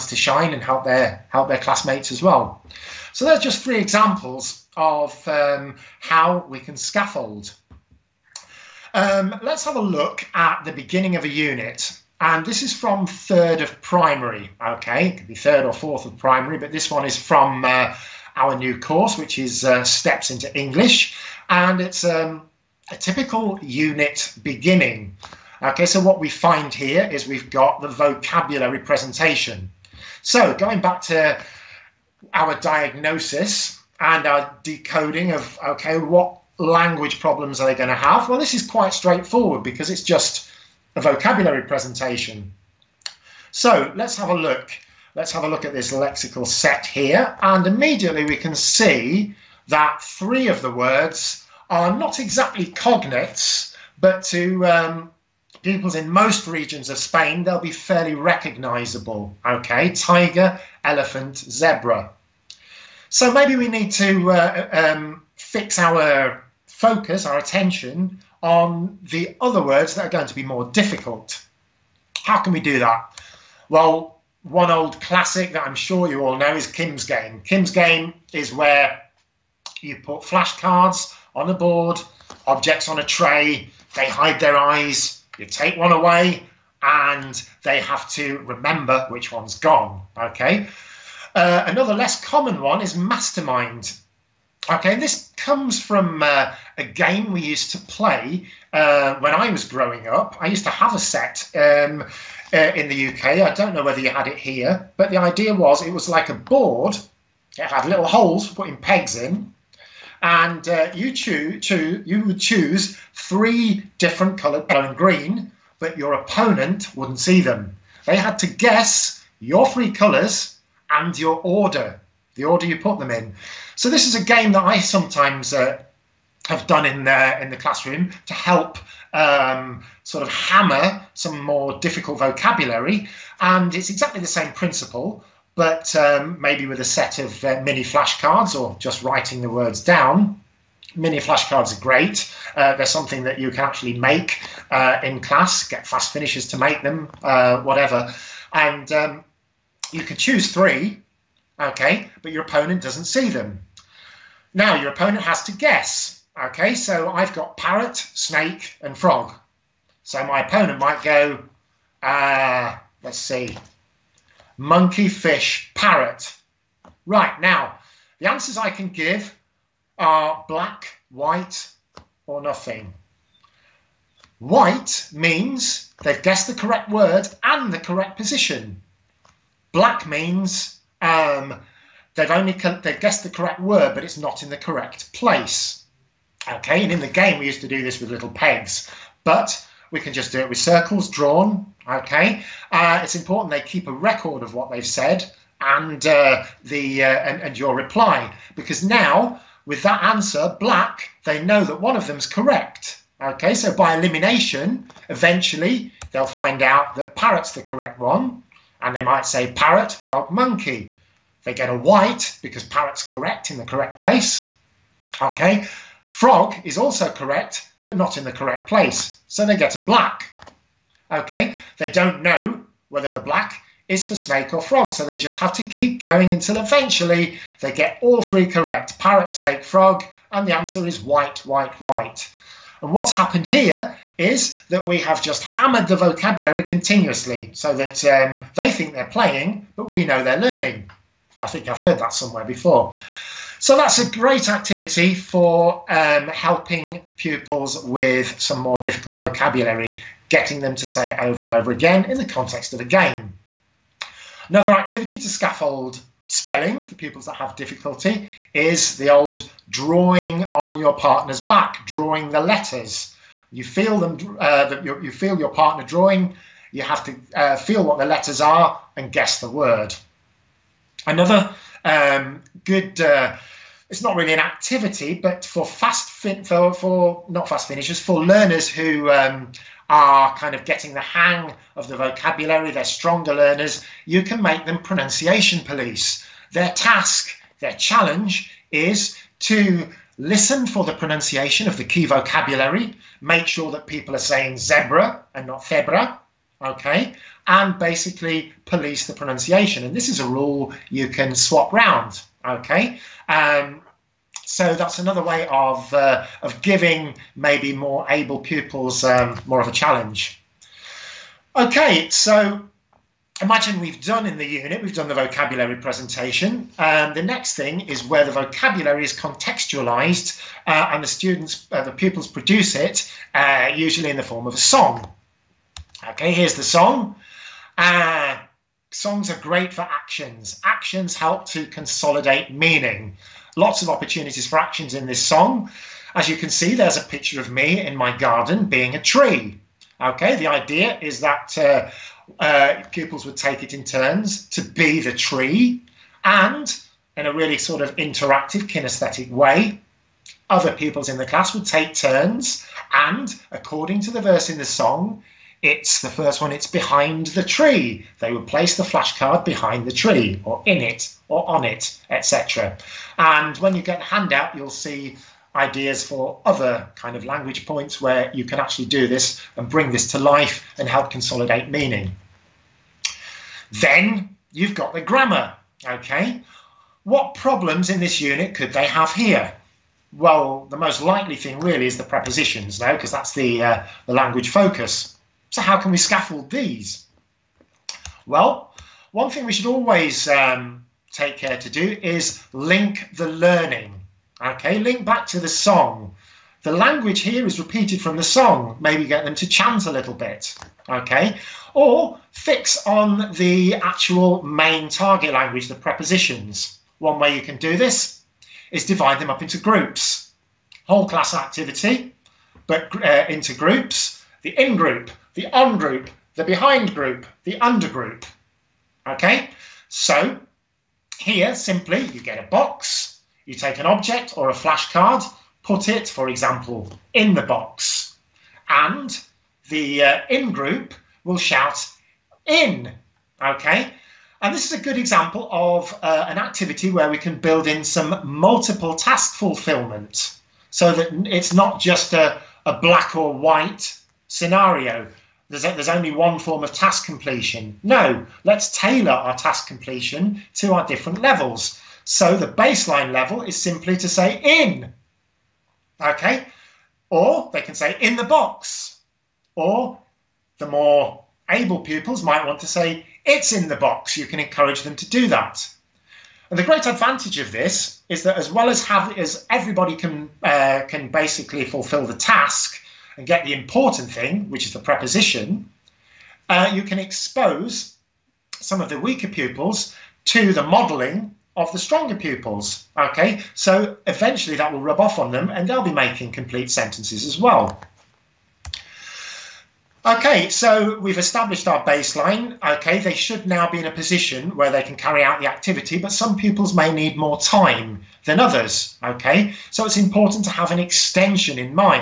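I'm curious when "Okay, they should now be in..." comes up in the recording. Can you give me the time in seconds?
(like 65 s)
492 s.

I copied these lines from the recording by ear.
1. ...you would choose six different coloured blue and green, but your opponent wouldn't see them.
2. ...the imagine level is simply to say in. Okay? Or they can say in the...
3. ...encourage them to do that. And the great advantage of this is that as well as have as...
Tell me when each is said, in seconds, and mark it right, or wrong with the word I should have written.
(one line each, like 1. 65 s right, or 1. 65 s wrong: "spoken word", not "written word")
1. 111 s wrong: "three", not "six"
2. 452 s wrong: "baseline", not "imagine"
3. 464 s right.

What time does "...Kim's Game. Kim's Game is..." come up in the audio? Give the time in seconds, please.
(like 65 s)
76 s.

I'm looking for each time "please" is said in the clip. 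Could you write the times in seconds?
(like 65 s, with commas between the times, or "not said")
not said.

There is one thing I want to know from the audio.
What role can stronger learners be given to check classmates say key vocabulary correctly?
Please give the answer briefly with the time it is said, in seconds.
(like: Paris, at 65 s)
pronunciation police, at 284 s.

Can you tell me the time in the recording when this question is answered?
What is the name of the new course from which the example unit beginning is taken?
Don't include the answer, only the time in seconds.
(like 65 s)
19 s.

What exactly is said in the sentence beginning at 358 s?
They would place the flashcard behind the tree, or in it, or on it, etc.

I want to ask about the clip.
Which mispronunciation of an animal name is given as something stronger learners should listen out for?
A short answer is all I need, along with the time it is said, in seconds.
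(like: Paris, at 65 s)
febra, at 295 s.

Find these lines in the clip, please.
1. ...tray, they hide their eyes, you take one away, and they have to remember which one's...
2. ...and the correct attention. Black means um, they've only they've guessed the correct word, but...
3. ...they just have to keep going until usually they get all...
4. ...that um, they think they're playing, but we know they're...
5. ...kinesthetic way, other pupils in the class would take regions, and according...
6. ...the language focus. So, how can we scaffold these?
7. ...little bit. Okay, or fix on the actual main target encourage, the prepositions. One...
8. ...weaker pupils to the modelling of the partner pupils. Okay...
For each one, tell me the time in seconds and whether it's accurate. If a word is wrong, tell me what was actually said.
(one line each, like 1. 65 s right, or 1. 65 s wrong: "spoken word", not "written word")
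1. 83 s right
2. 177 s wrong: "position", not "attention"
3. 225 s wrong: "eventually", not "usually"
4. 237 s right
5. 348 s wrong: "turns", not "regions"
6. 384 s right
7. 399 s wrong: "language", not "encourage"
8. 478 s wrong: "stronger", not "partner".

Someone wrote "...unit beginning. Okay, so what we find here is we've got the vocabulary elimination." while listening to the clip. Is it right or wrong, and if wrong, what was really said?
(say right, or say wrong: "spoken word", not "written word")
wrong: "presentation", not "elimination".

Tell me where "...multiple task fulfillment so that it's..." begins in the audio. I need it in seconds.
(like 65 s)
438 s.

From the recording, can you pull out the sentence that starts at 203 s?
Okay, so by elimination, eventually they'll find out that parrot's the correct one, and they might say parrot, frog, monkey.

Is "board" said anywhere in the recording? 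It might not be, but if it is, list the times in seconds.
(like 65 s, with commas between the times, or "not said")
81 s, 106 s.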